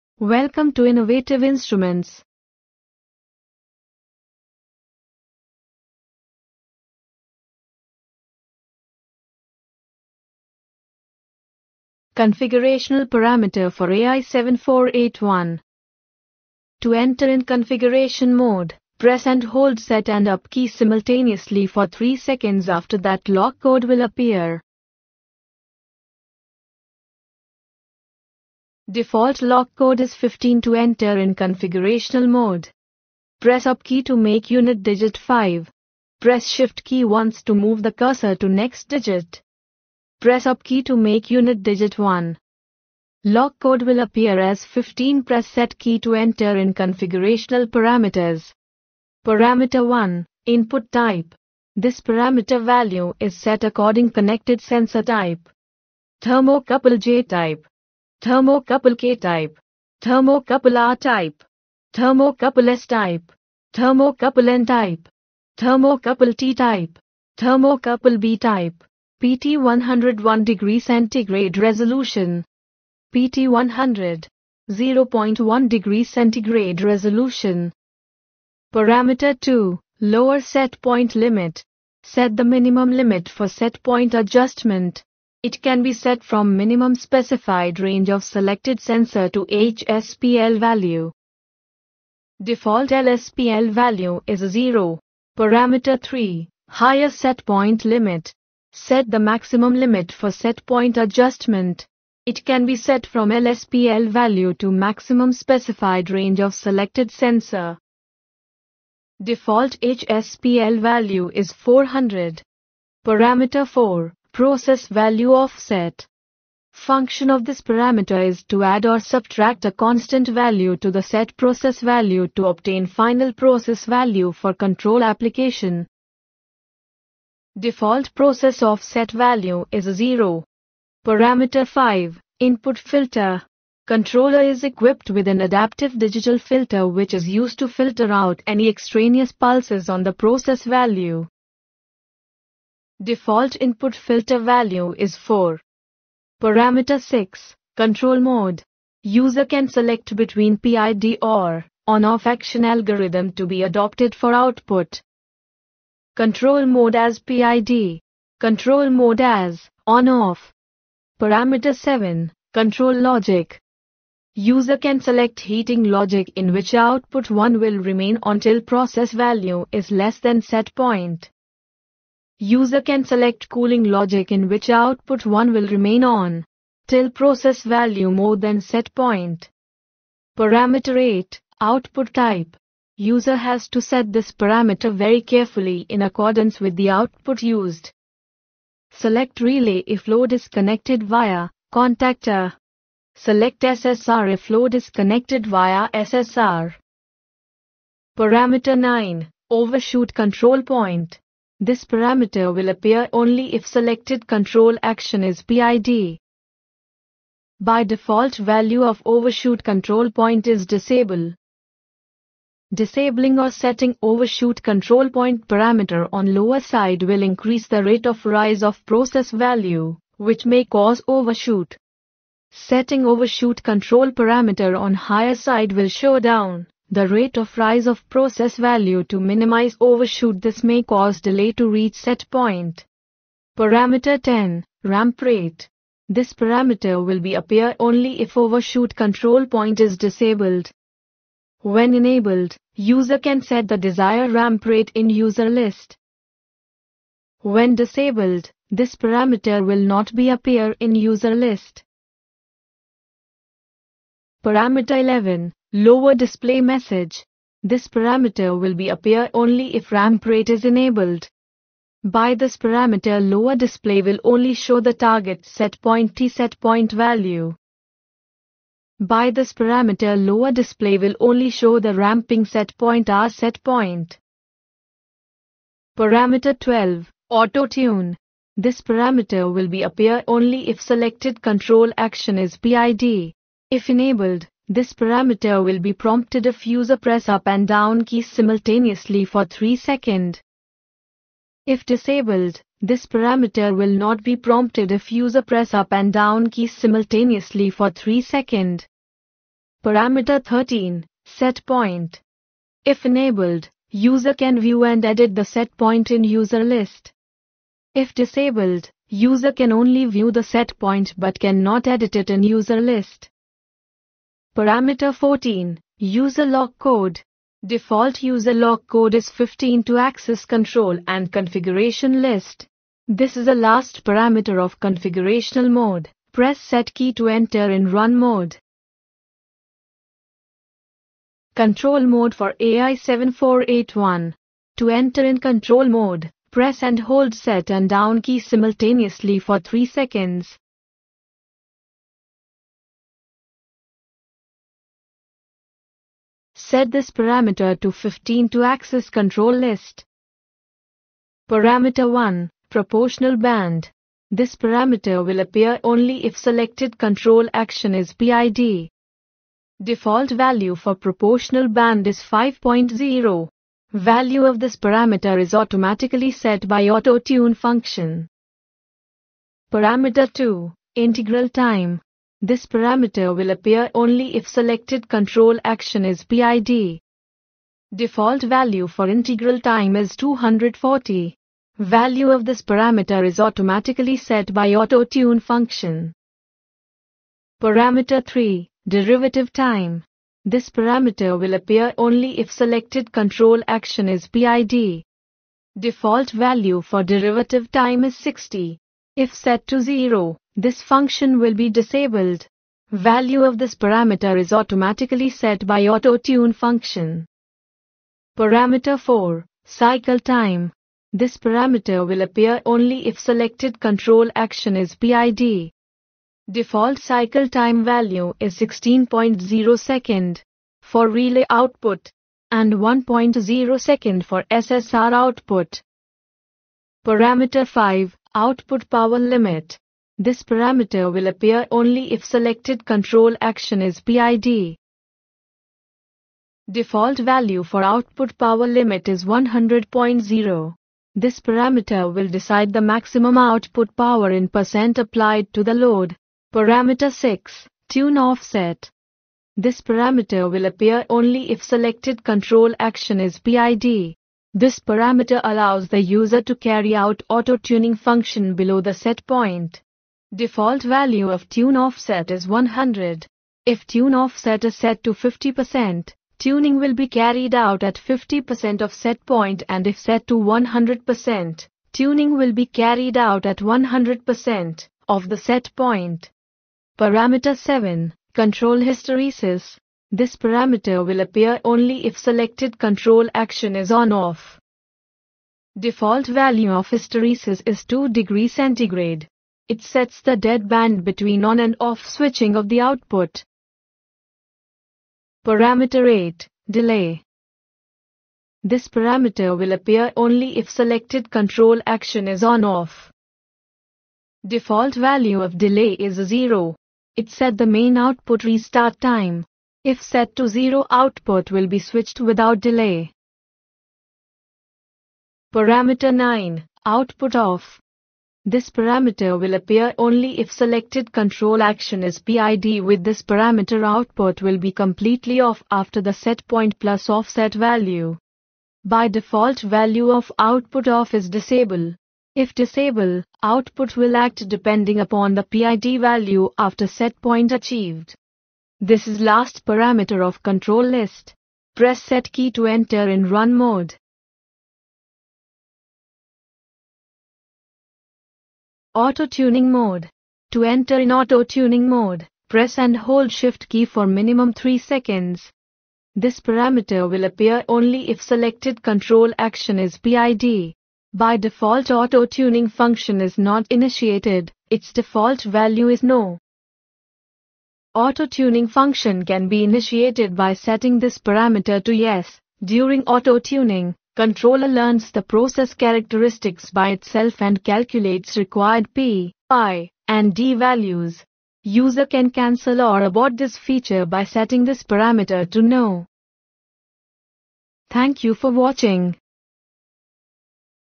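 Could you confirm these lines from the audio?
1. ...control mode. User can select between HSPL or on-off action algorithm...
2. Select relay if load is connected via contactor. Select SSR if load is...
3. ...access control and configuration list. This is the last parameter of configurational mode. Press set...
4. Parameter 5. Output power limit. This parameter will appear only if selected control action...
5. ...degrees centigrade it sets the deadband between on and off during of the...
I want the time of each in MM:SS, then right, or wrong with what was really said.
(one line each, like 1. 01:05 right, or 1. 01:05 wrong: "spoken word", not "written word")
1. 02:27 wrong: "PID", not "HSPL"
2. 03:08 right
3. 05:19 right
4. 07:07 right
5. 08:08 wrong: "switching", not "during".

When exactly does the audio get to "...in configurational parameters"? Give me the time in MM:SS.
00:46.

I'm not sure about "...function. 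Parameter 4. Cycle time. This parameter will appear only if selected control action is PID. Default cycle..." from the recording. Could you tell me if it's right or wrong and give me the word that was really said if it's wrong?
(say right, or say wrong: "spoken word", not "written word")
right.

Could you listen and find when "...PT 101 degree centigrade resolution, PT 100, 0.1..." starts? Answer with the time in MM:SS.
01:09.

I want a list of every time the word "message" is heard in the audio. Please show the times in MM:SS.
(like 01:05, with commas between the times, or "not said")
04:16.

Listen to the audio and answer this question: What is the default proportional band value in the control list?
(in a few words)
5.0.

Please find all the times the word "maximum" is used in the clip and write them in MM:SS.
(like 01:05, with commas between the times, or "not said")
01:39, 01:44, 07:22.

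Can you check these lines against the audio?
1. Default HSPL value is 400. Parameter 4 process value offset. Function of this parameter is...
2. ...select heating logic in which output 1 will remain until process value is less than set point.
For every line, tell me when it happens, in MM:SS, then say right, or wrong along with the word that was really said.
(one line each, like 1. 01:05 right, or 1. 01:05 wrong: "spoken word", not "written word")
1. 01:49 right
2. 02:44 right.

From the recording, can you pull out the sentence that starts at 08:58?
This is last parameter of control list.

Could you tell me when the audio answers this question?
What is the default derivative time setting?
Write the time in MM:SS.
06:37.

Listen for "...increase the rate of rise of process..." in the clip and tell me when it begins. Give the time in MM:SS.
03:37.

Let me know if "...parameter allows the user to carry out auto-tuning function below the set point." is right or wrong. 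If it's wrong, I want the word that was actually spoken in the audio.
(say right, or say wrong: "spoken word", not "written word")
right.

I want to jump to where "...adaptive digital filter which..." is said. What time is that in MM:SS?
02:15.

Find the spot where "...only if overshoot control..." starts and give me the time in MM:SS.
03:57.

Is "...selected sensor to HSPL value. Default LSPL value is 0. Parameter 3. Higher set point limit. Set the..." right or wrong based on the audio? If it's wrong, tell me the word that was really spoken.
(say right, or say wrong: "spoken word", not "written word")
right.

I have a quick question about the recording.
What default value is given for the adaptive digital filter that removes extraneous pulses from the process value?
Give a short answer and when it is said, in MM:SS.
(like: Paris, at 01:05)
4, at 02:23.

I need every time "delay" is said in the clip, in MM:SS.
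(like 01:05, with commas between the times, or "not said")
03:51, 08:16, 08:25, 08:32.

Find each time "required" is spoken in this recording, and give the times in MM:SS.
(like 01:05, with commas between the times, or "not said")
09:38.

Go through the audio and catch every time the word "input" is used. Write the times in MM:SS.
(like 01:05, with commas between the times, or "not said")
00:50, 02:12, 02:23.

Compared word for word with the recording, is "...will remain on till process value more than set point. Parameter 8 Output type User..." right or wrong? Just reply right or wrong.
right.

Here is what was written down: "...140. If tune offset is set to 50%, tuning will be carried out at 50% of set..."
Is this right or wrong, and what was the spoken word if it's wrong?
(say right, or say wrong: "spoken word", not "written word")
wrong: "100", not "140".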